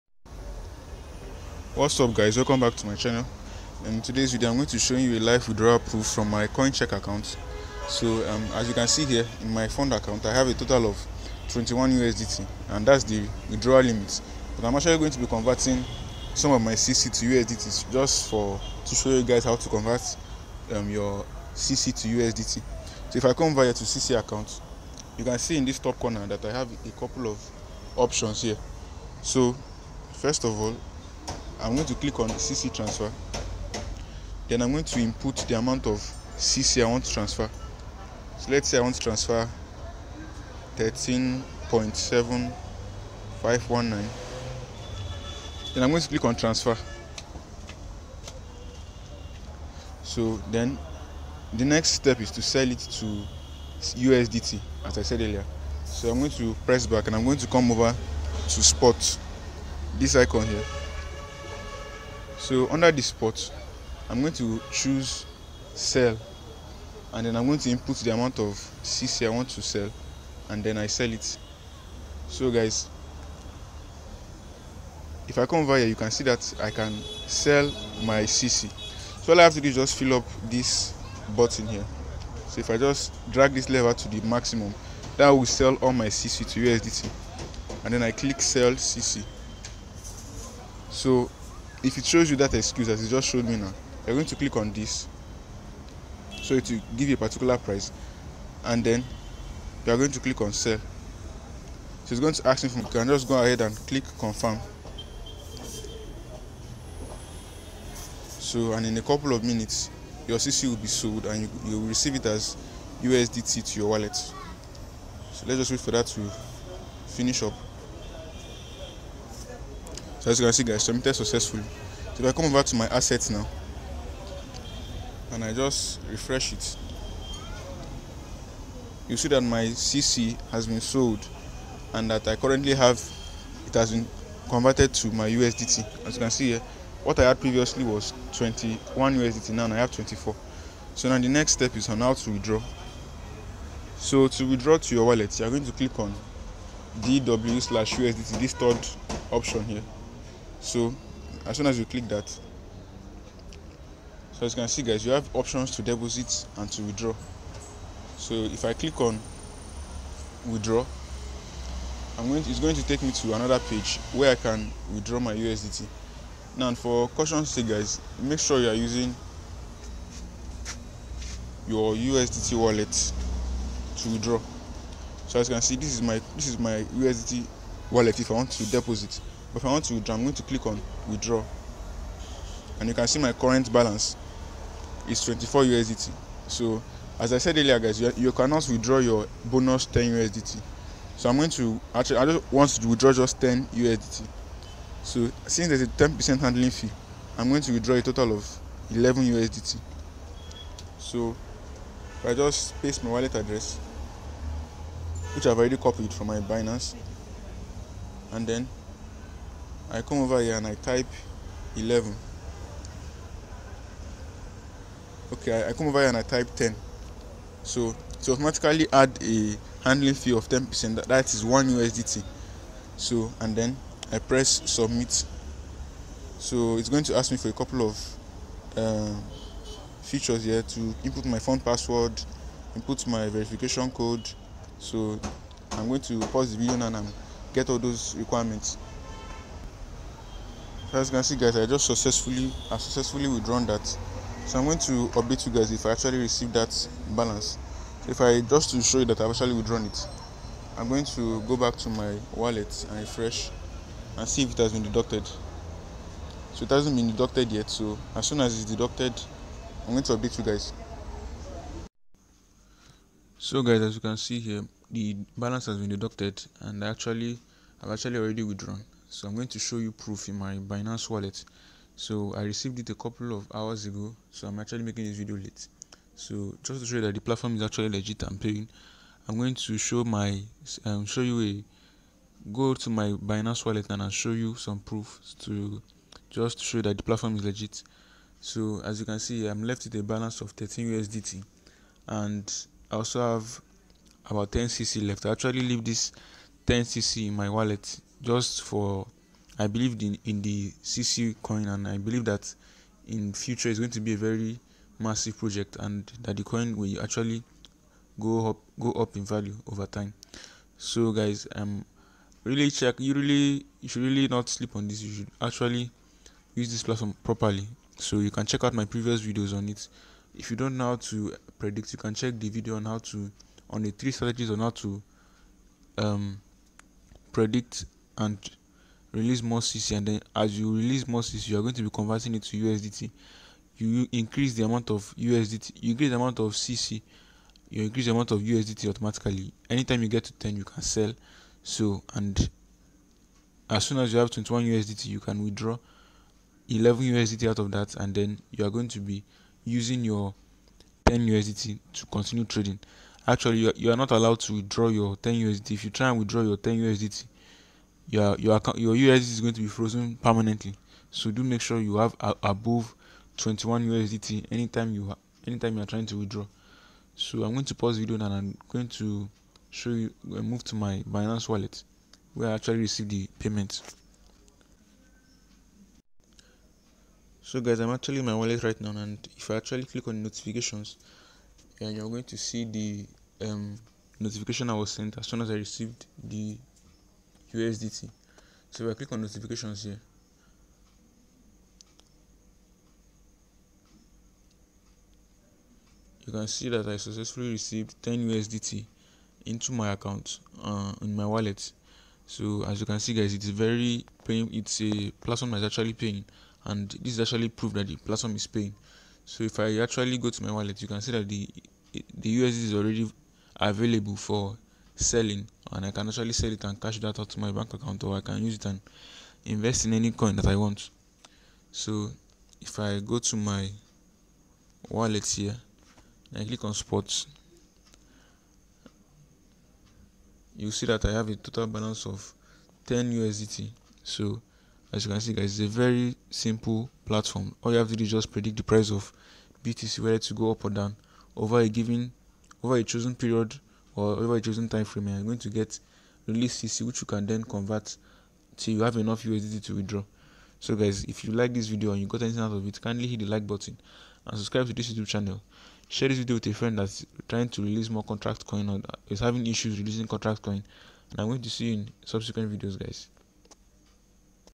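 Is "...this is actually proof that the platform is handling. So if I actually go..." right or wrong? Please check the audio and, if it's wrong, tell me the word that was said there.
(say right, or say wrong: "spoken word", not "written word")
wrong: "paying", not "handling".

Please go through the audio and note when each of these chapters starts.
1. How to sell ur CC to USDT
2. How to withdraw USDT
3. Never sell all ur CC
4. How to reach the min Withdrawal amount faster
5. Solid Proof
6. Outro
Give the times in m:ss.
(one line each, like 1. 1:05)
1. 0:33
2. 2:23
3. 4:50
4. 5:13
5. 6:16
6. 7:02.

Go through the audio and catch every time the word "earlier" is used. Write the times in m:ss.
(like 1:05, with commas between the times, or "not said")
0:55, 3:07.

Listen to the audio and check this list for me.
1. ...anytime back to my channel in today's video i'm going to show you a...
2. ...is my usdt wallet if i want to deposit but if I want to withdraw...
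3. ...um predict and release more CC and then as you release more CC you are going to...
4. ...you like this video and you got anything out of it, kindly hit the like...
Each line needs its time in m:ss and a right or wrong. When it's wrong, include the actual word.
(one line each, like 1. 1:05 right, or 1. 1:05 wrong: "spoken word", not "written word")
1. 0:02 wrong: "welcome", not "anytime"
2. 2:56 right
3. 5:25 right
4. 7:31 right.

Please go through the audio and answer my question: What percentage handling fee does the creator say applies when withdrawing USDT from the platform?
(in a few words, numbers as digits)
10%.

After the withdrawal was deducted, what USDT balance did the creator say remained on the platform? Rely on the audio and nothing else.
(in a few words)
13 USDT.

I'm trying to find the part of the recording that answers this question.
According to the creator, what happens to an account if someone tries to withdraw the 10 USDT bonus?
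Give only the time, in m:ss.
5:59.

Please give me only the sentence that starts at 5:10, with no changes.
So guys, um really check you really you should really not sleep on this.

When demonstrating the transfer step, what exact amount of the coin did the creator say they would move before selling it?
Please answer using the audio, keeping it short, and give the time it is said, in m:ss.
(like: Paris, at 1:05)
13.7519, at 0:40.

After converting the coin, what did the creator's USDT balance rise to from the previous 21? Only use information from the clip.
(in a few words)
24.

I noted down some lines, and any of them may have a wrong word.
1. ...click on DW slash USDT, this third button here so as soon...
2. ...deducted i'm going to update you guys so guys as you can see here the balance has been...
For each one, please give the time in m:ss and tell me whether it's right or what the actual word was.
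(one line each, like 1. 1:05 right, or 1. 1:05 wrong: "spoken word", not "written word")
1. 2:25 wrong: "option", not "button"
2. 4:18 right.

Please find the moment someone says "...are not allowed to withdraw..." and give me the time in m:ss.
5:53.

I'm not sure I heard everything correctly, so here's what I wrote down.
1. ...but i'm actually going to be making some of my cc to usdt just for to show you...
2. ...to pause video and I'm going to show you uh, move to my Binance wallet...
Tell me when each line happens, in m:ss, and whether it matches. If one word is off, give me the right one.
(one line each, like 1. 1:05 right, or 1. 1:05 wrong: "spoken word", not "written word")
1. 0:14 wrong: "converting", not "making"
2. 6:07 right.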